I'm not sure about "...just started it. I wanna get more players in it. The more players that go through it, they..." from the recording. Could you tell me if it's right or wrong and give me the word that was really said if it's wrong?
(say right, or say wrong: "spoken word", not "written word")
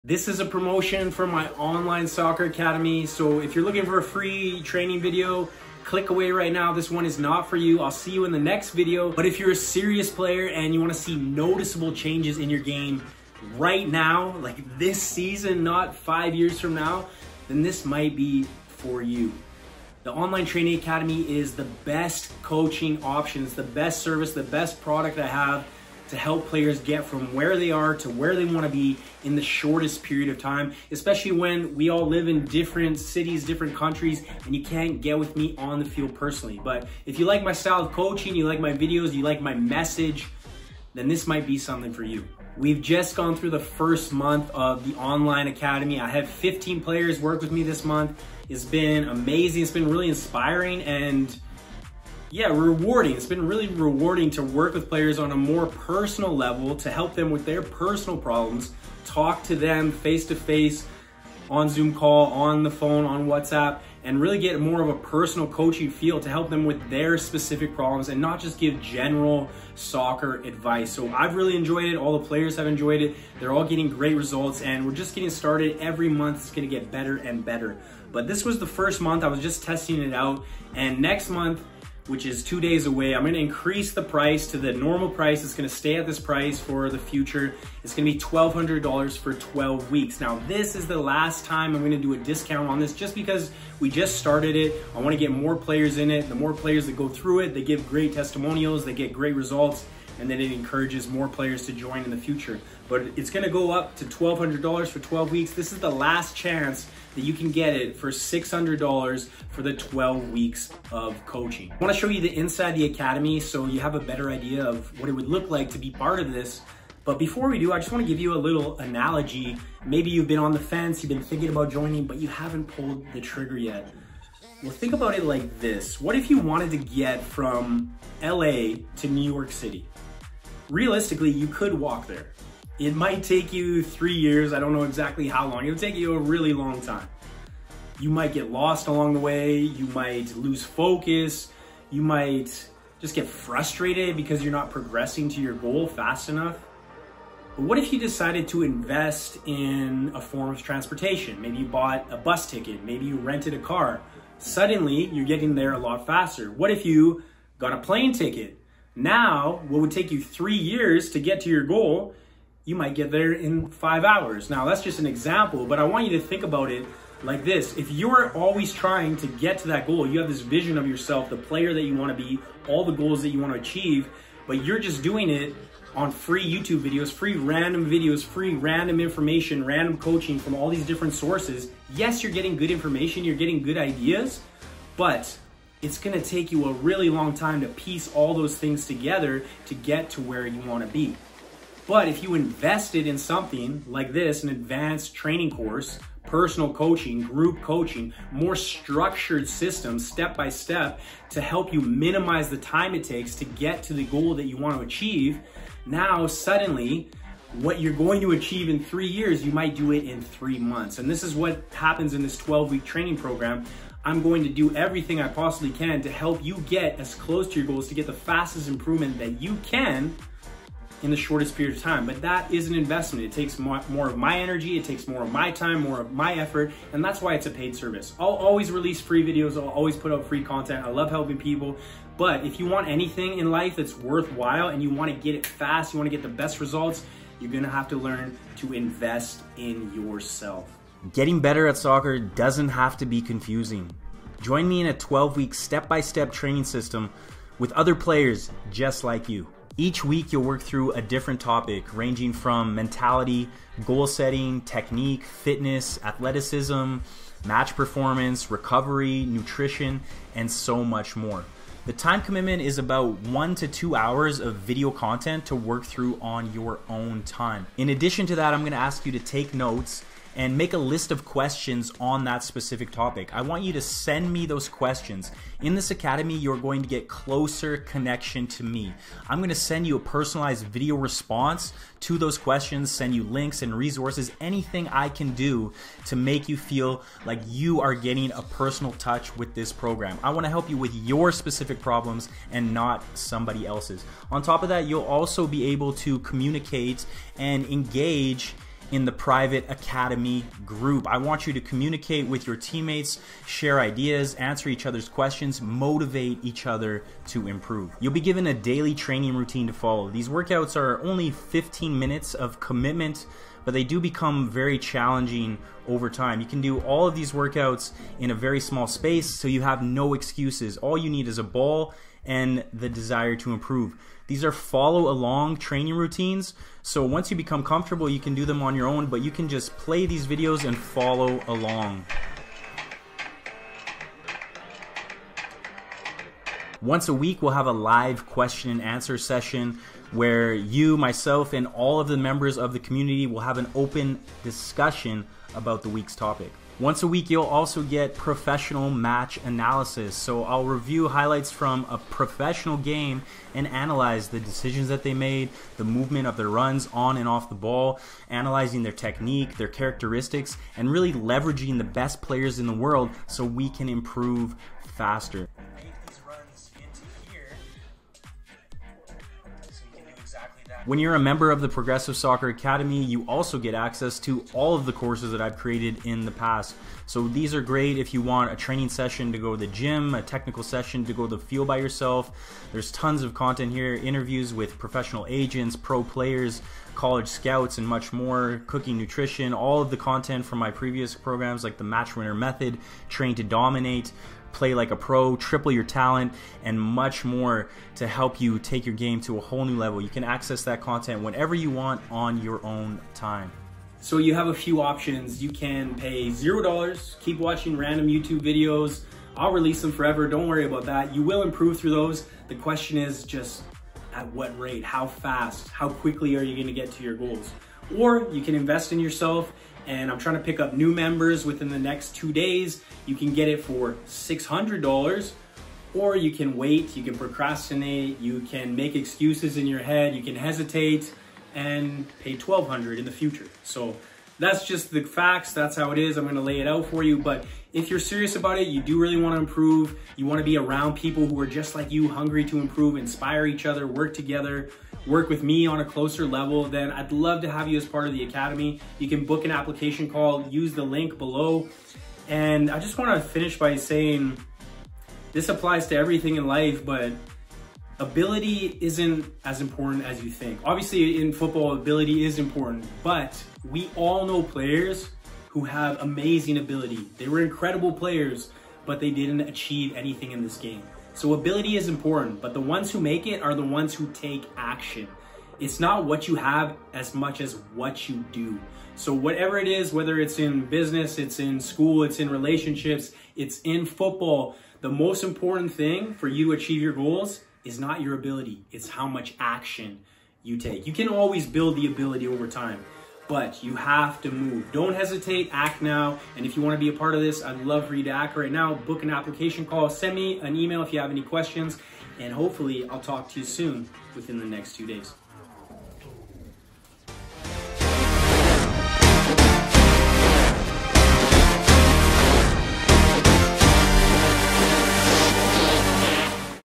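right.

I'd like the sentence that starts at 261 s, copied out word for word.
The time commitment is about one to two hours of video content to work through on your own time.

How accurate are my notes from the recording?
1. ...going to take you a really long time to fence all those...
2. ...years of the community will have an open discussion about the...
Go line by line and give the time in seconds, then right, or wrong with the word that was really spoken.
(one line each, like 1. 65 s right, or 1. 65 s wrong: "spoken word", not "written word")
1. 185 s wrong: "piece", not "fence"
2. 342 s wrong: "members", not "years".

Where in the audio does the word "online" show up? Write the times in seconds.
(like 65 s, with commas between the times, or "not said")
1 s, 20 s, 44 s.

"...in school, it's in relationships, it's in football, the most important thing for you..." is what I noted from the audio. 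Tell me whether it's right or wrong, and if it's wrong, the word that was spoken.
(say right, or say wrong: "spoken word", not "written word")
right.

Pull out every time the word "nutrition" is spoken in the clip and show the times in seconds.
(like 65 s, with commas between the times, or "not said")
259 s, 388 s.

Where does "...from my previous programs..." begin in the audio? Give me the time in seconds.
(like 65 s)
390 s.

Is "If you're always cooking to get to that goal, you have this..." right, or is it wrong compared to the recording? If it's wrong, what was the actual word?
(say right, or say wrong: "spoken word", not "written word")
wrong: "trying", not "cooking".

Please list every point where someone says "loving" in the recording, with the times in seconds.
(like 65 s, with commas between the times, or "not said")
not said.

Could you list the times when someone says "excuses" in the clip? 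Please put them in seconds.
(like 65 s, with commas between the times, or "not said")
320 s, 428 s.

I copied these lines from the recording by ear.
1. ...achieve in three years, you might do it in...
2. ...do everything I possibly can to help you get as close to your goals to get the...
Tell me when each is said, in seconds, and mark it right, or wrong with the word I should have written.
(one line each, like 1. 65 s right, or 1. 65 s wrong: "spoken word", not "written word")
1. 208 s right
2. 214 s right.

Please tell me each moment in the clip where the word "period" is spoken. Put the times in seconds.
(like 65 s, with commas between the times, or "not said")
30 s, 221 s.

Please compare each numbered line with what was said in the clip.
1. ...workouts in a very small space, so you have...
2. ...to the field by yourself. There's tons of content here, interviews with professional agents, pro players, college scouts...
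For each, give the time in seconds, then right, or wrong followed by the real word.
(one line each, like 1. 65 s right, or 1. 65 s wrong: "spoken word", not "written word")
1. 317 s right
2. 381 s right.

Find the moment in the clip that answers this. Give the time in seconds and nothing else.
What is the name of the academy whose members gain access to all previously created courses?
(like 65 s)
371 s.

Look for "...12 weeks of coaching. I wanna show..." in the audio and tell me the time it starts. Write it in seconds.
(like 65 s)
109 s.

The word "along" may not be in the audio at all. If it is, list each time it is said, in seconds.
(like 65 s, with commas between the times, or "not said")
138 s, 325 s, 331 s.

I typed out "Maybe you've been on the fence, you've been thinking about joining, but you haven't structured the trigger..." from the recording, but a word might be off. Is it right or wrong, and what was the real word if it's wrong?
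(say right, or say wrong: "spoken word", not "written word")
wrong: "pulled", not "structured".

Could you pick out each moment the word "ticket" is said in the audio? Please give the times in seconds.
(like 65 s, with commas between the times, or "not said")
152 s, 158 s.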